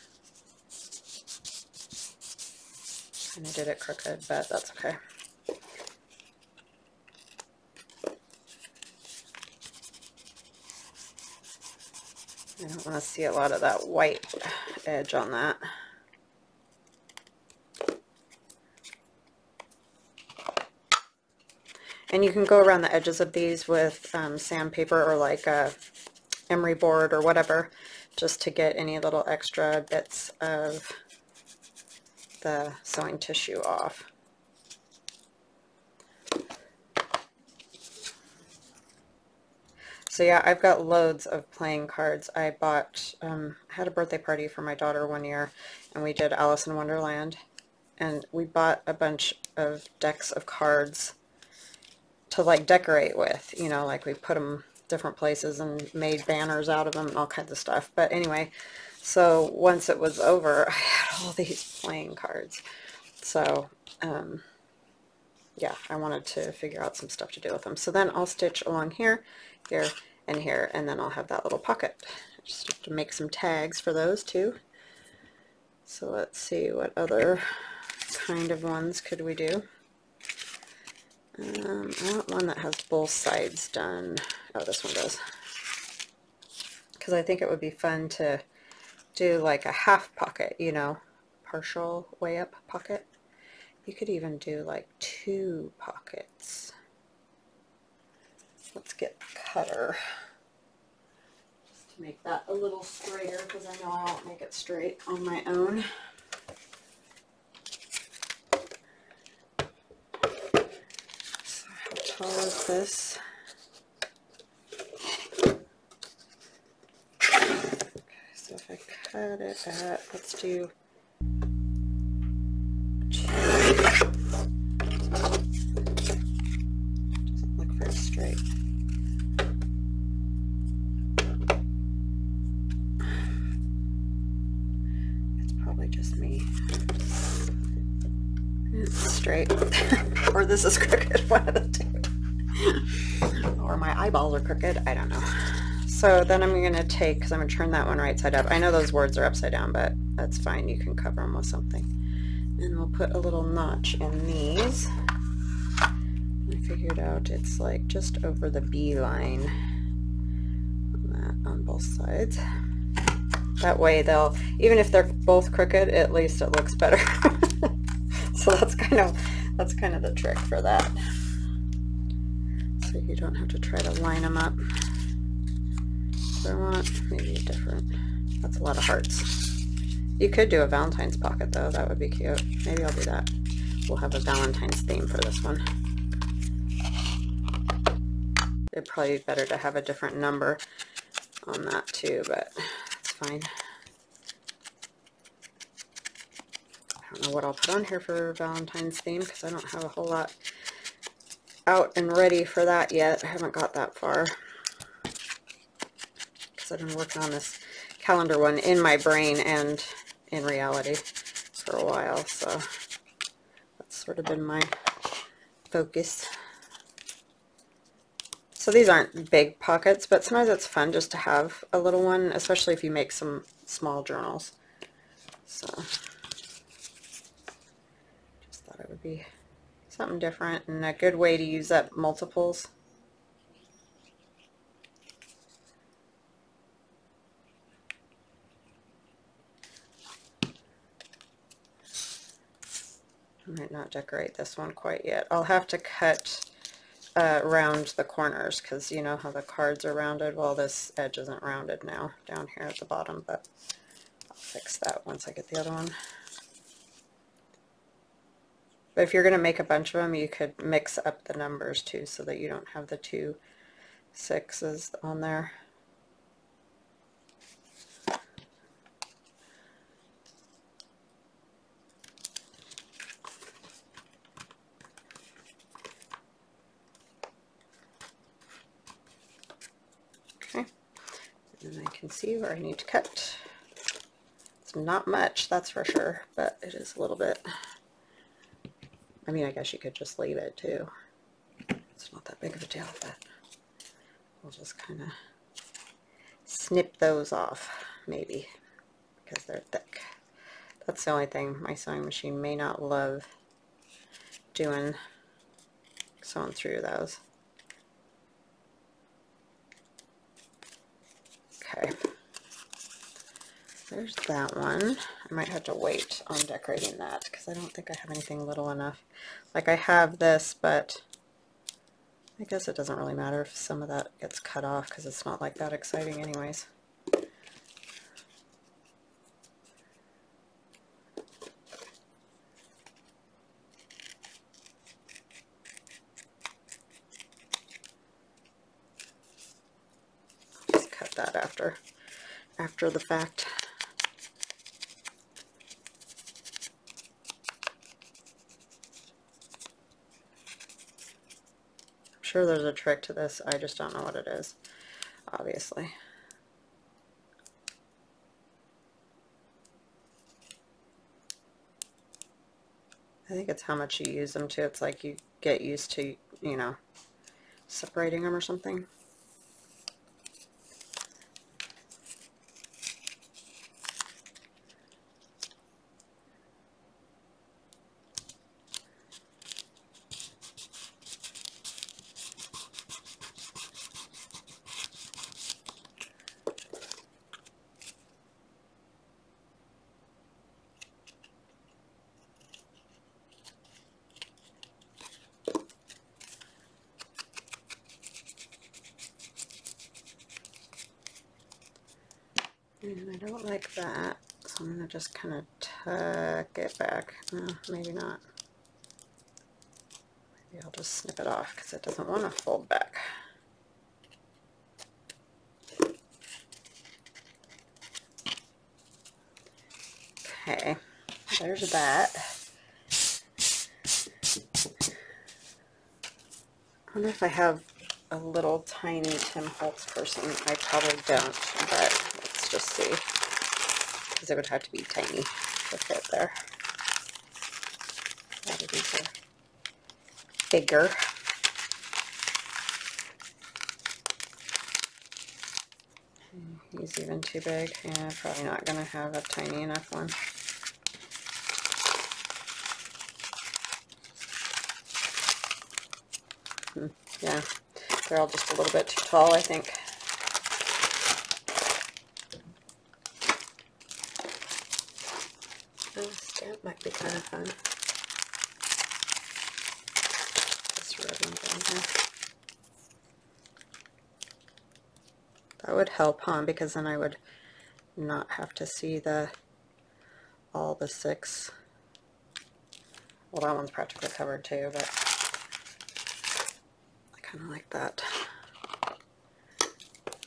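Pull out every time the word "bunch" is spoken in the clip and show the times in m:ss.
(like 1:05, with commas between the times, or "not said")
0:48, 4:19.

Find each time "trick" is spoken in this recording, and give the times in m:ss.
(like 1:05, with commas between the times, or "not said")
2:50, 5:52.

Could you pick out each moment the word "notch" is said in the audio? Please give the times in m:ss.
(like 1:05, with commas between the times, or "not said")
2:33.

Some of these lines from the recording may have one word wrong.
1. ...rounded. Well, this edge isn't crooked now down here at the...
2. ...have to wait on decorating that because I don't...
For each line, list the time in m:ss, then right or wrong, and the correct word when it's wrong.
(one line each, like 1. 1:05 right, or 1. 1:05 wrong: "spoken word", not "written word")
1. 4:09 wrong: "rounded", not "crooked"
2. 5:15 right.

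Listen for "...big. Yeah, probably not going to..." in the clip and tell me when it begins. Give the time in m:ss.
7:27.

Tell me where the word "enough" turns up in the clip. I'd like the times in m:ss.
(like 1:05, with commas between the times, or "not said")
5:18, 7:29.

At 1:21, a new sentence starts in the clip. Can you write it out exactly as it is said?
Um, I want one that has both sides done.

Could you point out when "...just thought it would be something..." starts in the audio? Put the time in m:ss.
3:45.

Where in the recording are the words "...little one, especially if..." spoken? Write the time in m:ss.
3:41.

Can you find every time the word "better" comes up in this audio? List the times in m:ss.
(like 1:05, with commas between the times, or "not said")
2:46, 3:09.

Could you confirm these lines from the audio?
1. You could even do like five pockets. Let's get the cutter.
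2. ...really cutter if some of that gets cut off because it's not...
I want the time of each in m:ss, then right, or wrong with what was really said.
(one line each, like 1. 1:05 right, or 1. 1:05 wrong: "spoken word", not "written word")
1. 1:33 wrong: "two", not "five"
2. 5:22 wrong: "matter", not "cutter".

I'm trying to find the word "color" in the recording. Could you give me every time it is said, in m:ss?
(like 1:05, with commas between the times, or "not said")
1:52.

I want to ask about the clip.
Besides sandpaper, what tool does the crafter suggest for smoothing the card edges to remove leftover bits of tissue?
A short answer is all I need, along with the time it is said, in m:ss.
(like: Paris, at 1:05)
emery board, at 0:26.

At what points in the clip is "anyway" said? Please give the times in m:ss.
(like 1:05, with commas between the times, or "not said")
0:58, 5:26.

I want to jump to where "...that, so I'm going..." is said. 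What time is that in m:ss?
6:43.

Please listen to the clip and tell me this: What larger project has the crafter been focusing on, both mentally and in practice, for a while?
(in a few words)
calendar.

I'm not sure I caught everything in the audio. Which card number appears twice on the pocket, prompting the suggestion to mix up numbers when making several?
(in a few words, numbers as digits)
6.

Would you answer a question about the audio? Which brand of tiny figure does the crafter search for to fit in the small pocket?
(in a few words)
Tim Holtz.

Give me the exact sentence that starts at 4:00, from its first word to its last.
I might not decorate this one quite yet.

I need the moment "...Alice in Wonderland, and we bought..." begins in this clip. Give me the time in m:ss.
0:46.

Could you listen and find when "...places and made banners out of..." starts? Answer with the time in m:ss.
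0:55.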